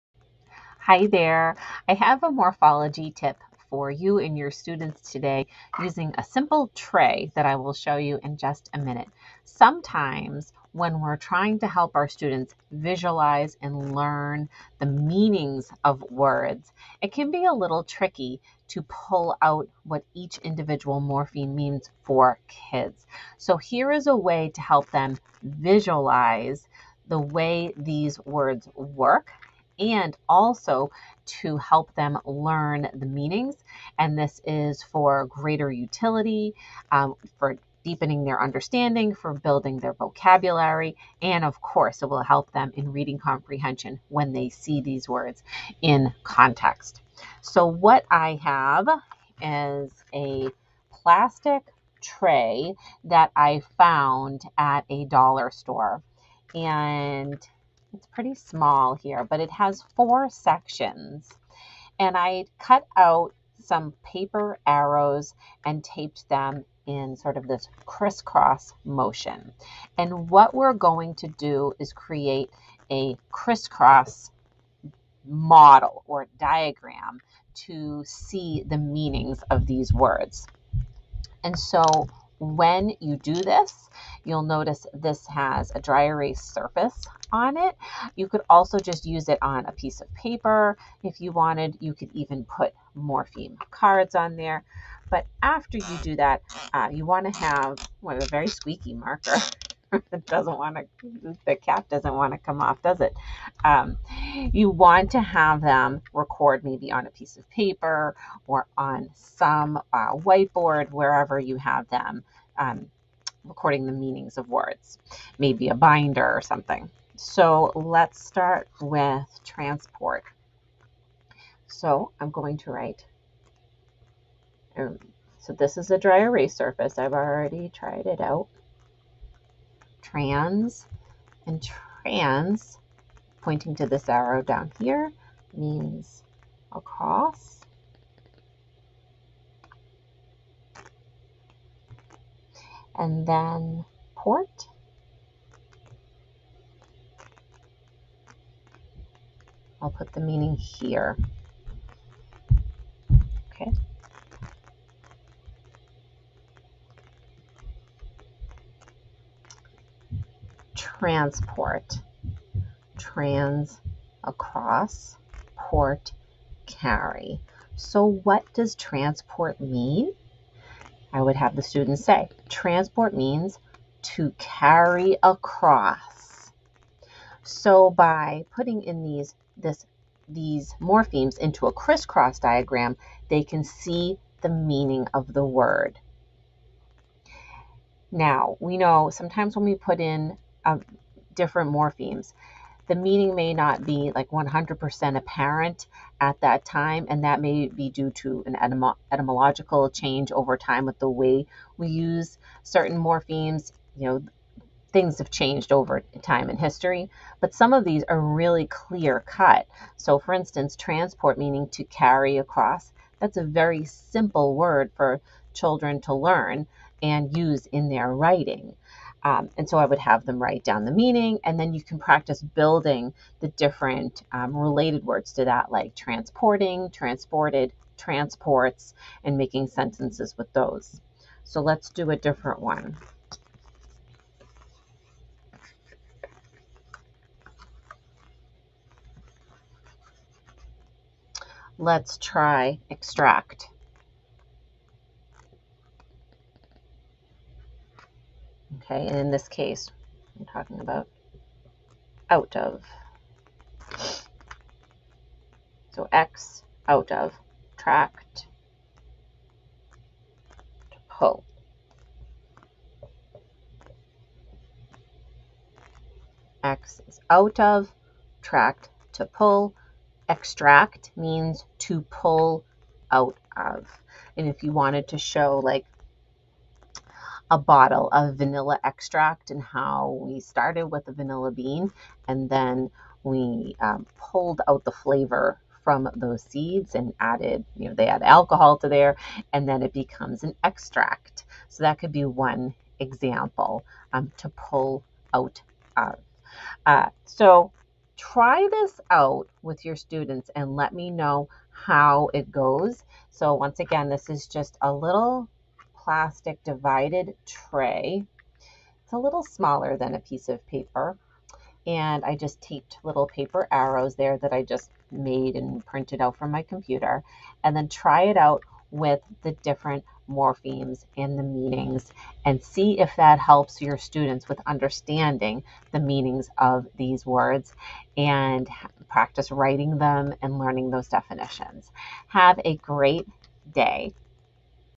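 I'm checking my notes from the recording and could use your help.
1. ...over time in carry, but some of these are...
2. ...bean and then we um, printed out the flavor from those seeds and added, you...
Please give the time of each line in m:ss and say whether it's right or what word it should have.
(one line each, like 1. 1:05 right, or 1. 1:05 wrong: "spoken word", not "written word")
1. 3:25 wrong: "history", not "carry"
2. 4:41 wrong: "pulled", not "printed".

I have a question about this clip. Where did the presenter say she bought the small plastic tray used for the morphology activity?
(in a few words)
a dollar store.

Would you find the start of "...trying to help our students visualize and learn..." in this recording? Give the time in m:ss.
0:11.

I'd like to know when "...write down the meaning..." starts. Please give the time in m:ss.
3:40.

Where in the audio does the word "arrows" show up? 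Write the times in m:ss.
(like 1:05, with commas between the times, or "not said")
1:04, 2:14, 5:13.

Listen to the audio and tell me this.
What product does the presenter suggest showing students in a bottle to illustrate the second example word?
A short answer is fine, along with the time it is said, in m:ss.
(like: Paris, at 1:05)
vanilla extract, at 4:38.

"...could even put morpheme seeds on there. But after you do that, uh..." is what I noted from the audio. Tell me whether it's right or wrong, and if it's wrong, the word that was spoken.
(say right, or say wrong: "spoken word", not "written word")
wrong: "cards", not "seeds".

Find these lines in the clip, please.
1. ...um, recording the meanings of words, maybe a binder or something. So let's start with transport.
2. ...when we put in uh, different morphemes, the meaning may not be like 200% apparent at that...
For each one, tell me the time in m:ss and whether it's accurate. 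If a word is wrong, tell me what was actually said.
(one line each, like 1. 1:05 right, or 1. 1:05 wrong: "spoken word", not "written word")
1. 1:52 right
2. 3:09 wrong: "100", not "200".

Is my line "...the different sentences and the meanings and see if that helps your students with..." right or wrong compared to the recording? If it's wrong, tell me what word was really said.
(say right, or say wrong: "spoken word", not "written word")
wrong: "morphemes", not "sentences".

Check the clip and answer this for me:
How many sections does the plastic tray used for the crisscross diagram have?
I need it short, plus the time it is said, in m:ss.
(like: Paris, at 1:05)
4, at 0:59.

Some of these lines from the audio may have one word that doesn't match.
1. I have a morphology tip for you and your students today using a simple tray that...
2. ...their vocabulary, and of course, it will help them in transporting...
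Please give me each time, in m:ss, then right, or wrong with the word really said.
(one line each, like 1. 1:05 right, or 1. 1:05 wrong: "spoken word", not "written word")
1. 0:01 right
2. 0:39 wrong: "reading", not "transporting".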